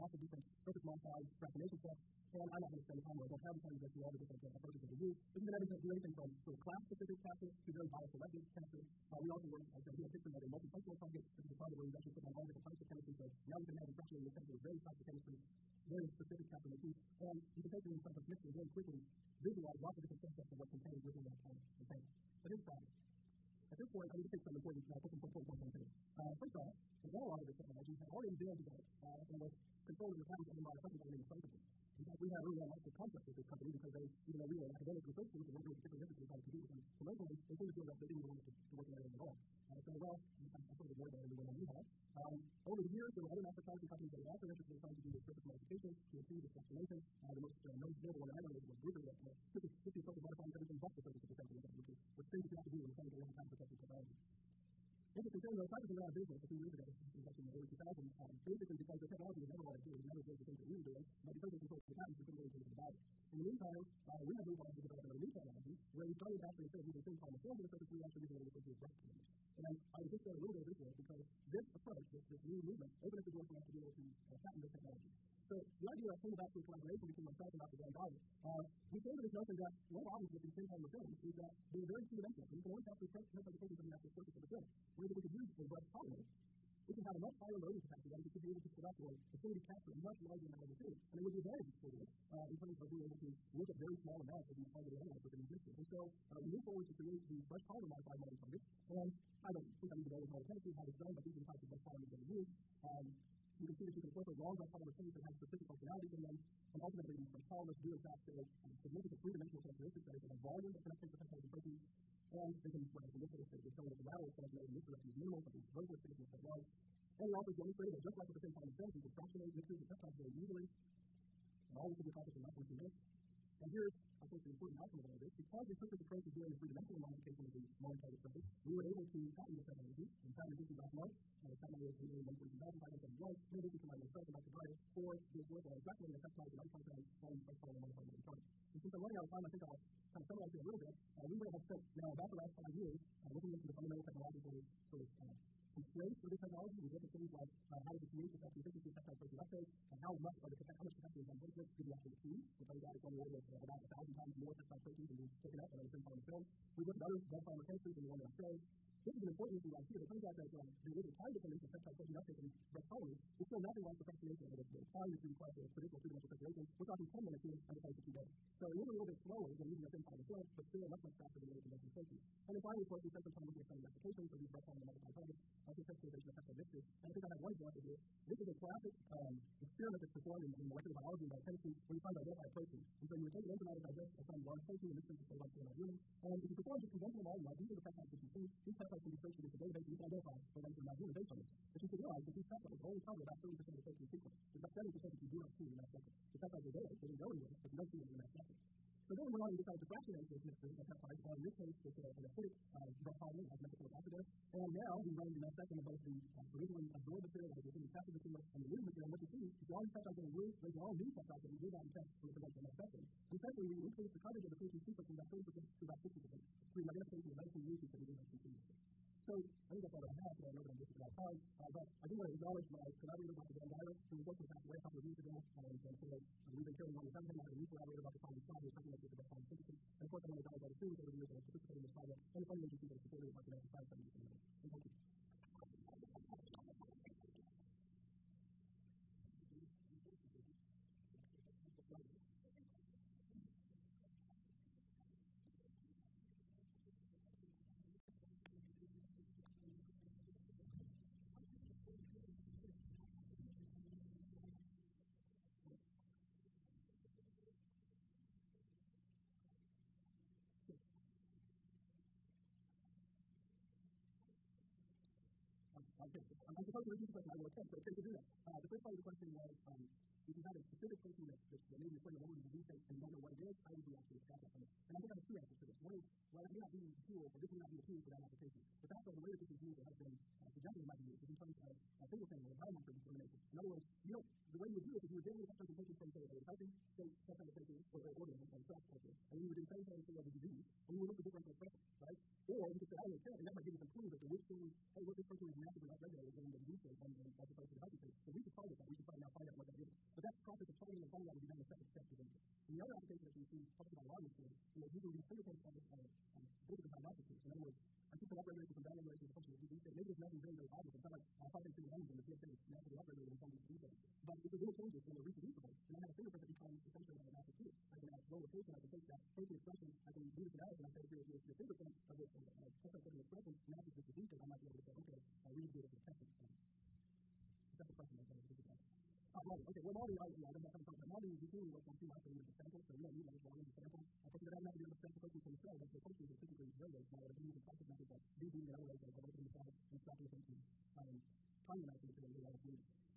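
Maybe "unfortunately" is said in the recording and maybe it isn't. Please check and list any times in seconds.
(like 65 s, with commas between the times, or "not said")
224 s.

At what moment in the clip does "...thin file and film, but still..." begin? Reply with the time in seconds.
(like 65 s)
169 s.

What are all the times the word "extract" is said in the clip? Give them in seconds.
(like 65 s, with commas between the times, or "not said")
274 s.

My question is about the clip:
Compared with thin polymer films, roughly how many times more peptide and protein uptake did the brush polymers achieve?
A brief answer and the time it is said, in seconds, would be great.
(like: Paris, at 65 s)
1,000, at 153 s.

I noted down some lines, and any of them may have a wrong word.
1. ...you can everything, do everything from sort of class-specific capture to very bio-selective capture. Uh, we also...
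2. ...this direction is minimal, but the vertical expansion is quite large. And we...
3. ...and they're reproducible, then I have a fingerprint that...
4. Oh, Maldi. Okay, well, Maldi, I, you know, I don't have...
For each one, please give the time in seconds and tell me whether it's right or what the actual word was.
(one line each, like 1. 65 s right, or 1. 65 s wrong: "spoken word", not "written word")
1. 5 s right
2. 114 s right
3. 315 s right
4. 329 s right.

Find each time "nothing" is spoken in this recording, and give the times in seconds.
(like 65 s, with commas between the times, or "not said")
163 s, 310 s.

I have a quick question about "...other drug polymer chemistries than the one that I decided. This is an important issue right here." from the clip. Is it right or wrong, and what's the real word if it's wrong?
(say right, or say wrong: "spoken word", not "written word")
wrong: "showed", not "decided".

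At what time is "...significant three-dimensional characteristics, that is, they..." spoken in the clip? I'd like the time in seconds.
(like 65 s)
108 s.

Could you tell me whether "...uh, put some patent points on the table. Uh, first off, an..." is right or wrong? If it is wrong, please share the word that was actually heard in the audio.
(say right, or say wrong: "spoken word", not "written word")
wrong: "important", not "patent".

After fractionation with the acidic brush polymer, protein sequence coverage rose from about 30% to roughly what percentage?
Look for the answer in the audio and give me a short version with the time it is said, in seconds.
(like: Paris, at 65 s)
60%, at 215 s.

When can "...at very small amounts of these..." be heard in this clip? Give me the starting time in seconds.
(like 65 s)
93 s.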